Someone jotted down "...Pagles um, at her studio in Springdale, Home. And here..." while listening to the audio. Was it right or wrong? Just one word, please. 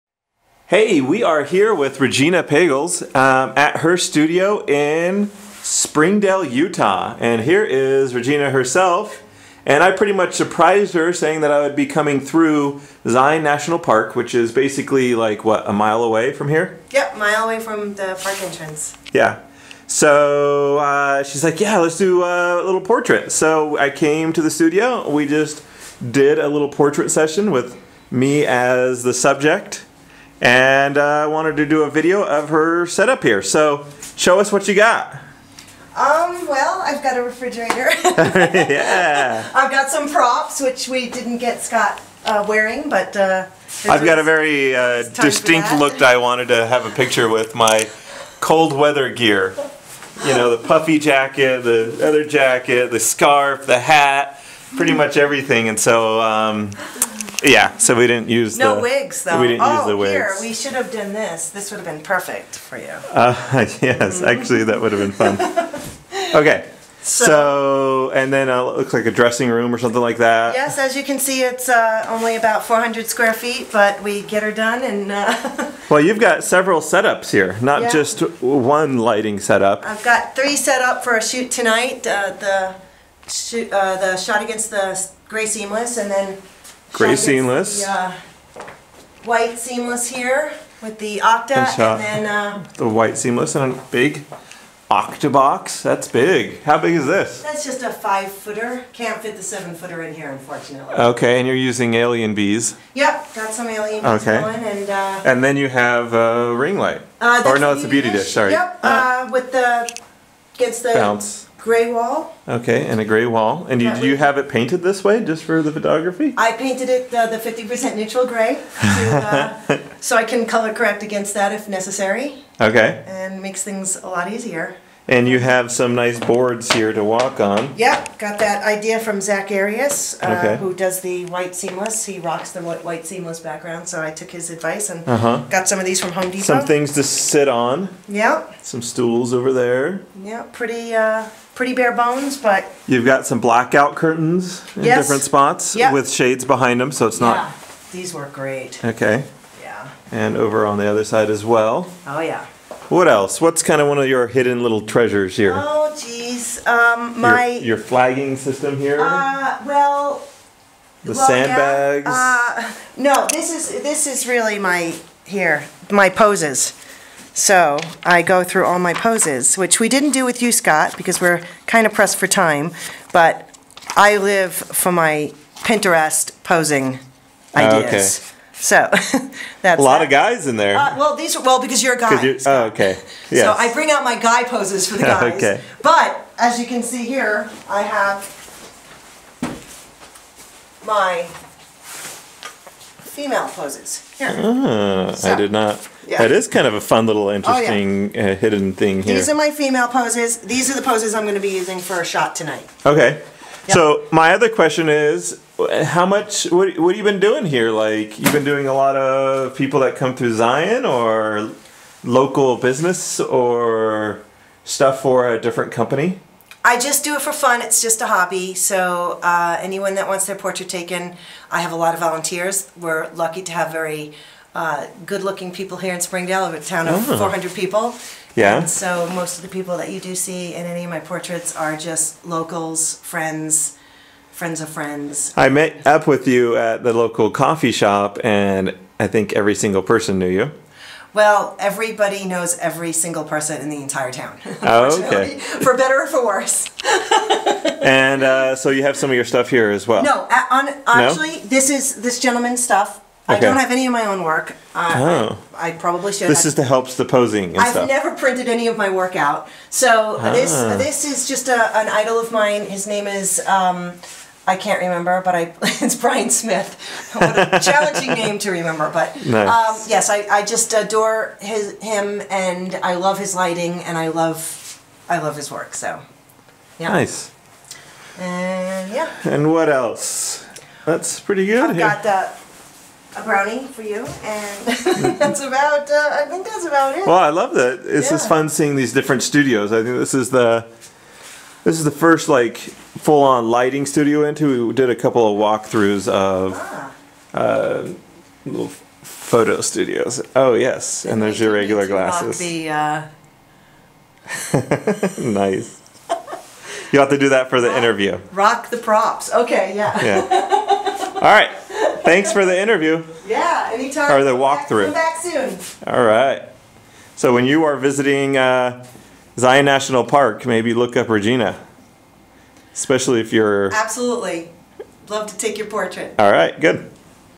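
wrong.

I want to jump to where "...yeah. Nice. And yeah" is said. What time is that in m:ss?
4:36.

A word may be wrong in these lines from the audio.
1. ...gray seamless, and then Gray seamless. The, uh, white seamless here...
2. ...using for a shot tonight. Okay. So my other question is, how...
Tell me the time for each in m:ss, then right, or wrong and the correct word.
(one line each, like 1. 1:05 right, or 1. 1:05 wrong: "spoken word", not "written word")
1. 1:25 right
2. 3:21 right.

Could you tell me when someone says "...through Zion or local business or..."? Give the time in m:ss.
3:30.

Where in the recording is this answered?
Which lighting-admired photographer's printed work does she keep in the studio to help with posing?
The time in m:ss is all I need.
4:25.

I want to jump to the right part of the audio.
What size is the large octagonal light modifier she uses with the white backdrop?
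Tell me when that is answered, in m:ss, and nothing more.
1:37.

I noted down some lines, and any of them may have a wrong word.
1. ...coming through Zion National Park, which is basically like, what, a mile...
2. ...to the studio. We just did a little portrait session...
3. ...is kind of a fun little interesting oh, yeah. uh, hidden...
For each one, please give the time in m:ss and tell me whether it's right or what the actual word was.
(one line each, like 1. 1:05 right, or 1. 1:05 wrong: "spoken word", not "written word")
1. 0:11 right
2. 0:24 right
3. 3:16 right.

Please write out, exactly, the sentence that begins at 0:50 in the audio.
You know, the puffy jacket, the other jacket, the scarf, the hat, pretty much everything.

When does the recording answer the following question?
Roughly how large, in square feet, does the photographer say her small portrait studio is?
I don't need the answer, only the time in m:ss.
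1:12.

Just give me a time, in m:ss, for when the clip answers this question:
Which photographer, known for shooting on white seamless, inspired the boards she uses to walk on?
2:09.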